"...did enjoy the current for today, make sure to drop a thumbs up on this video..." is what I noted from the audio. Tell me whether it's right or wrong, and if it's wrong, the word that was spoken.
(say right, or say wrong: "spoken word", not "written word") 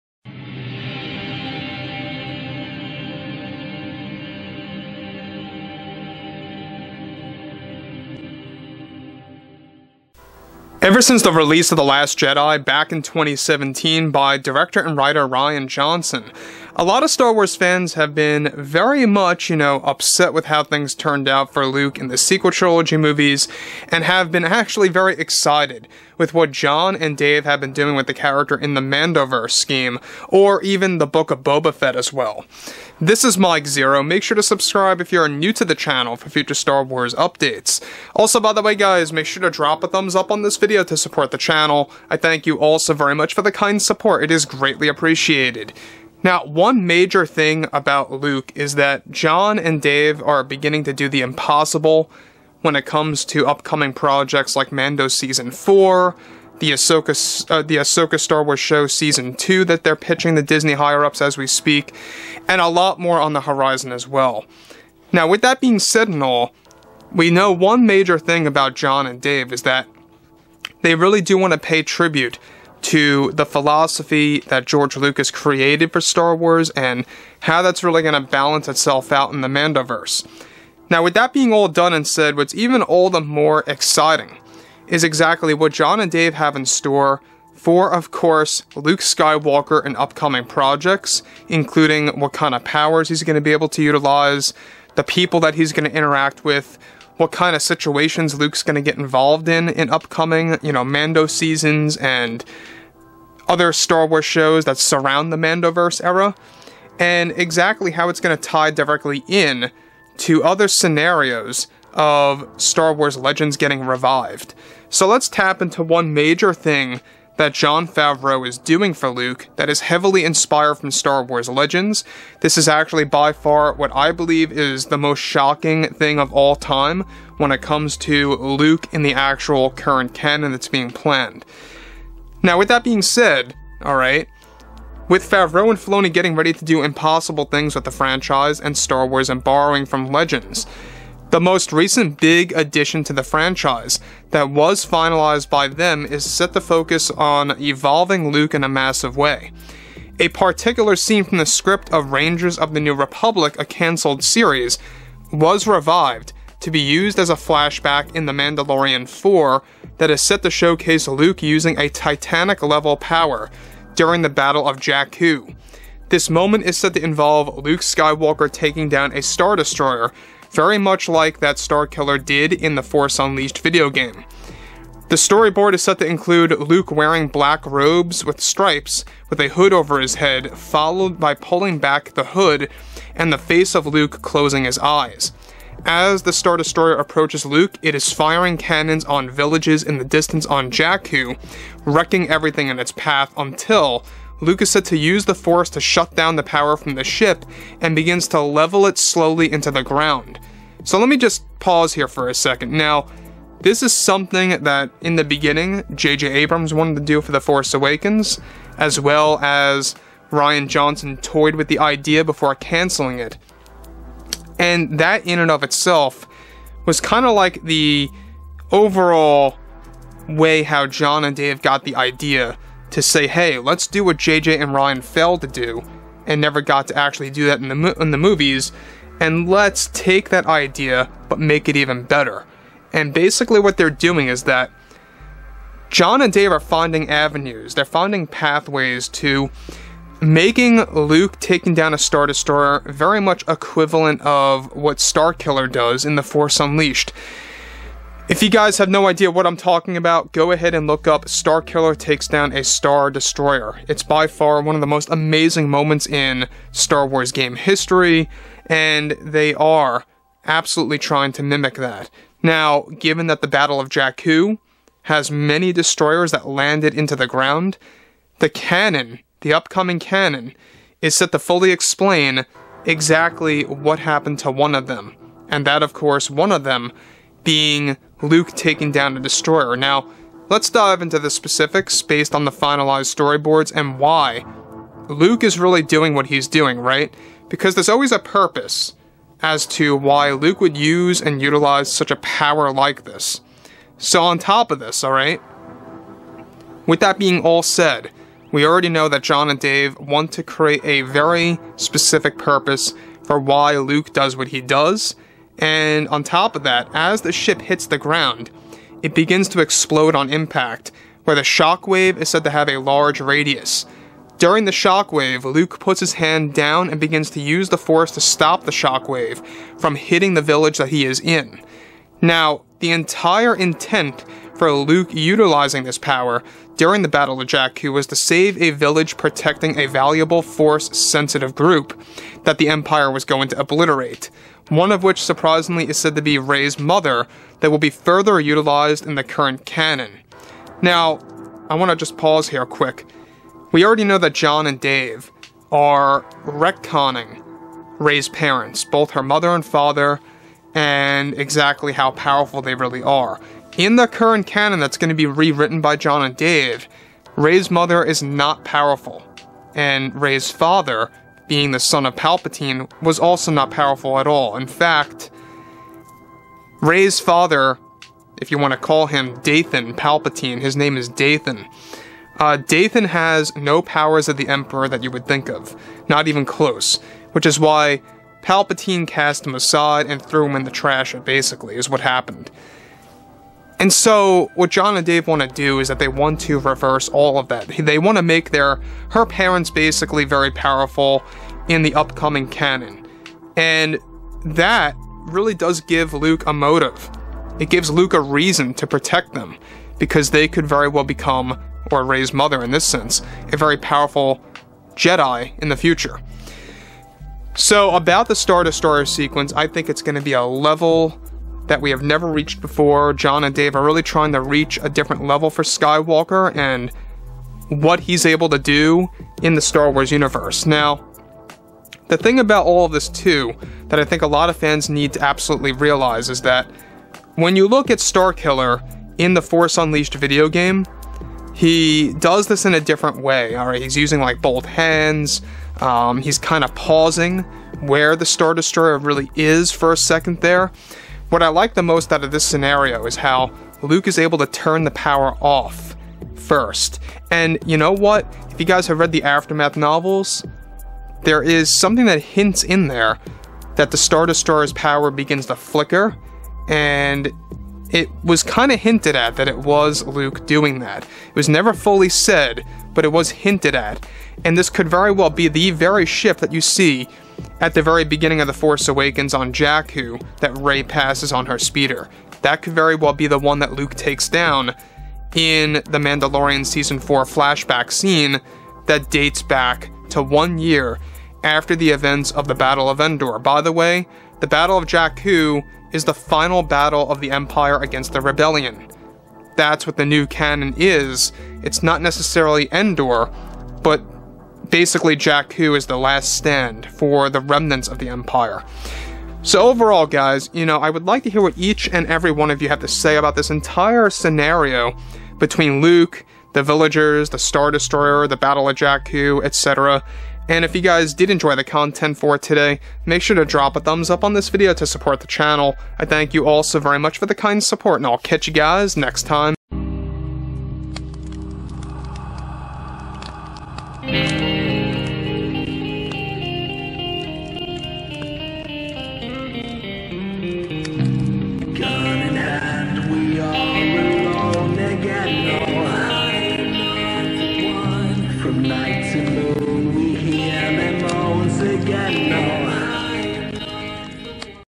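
wrong: "content", not "current".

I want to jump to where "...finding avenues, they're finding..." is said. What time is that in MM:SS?
03:56.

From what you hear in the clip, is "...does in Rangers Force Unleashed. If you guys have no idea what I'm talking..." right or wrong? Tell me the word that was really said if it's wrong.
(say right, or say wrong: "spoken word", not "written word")
wrong: "The", not "Rangers".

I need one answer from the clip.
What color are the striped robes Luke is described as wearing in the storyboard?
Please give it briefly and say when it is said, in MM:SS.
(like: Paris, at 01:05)
Black, at 02:57.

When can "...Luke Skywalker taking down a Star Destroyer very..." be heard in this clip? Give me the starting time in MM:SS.
02:47.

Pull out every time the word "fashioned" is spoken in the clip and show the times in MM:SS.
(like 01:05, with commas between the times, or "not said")
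not said.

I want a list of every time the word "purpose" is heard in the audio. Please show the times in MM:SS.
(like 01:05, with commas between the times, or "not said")
04:48, 05:02.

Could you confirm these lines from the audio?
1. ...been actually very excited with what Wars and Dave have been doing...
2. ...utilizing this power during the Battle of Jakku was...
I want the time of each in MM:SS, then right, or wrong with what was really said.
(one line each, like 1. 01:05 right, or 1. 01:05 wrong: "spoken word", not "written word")
1. 00:24 wrong: "Jon", not "Wars"
2. 05:25 right.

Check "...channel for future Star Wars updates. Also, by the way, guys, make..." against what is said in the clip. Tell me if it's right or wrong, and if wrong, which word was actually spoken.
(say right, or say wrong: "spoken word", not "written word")
right.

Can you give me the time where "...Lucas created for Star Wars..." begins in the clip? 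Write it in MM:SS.
01:14.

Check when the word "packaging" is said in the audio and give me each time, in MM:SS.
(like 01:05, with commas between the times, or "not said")
not said.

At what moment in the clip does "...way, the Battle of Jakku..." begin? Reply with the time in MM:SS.
08:03.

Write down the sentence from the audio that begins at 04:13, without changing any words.
It's by far one of the most amazing moments in Star Wars game history, and they are absolutely trying to mimic that.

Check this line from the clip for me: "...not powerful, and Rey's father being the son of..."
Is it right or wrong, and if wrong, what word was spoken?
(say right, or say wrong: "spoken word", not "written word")
right.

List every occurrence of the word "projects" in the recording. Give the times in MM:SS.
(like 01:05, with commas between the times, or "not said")
00:53, 01:30.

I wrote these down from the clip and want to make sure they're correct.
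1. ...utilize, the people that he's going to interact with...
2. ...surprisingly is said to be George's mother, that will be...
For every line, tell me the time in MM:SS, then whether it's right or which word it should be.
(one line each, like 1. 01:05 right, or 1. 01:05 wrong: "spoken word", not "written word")
1. 01:33 right
2. 05:35 wrong: "Rey", not "George".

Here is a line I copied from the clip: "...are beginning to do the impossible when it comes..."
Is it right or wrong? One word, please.
right.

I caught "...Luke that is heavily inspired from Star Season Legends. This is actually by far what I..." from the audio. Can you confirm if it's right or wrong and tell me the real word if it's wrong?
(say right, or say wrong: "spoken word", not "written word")
wrong: "Wars", not "Season".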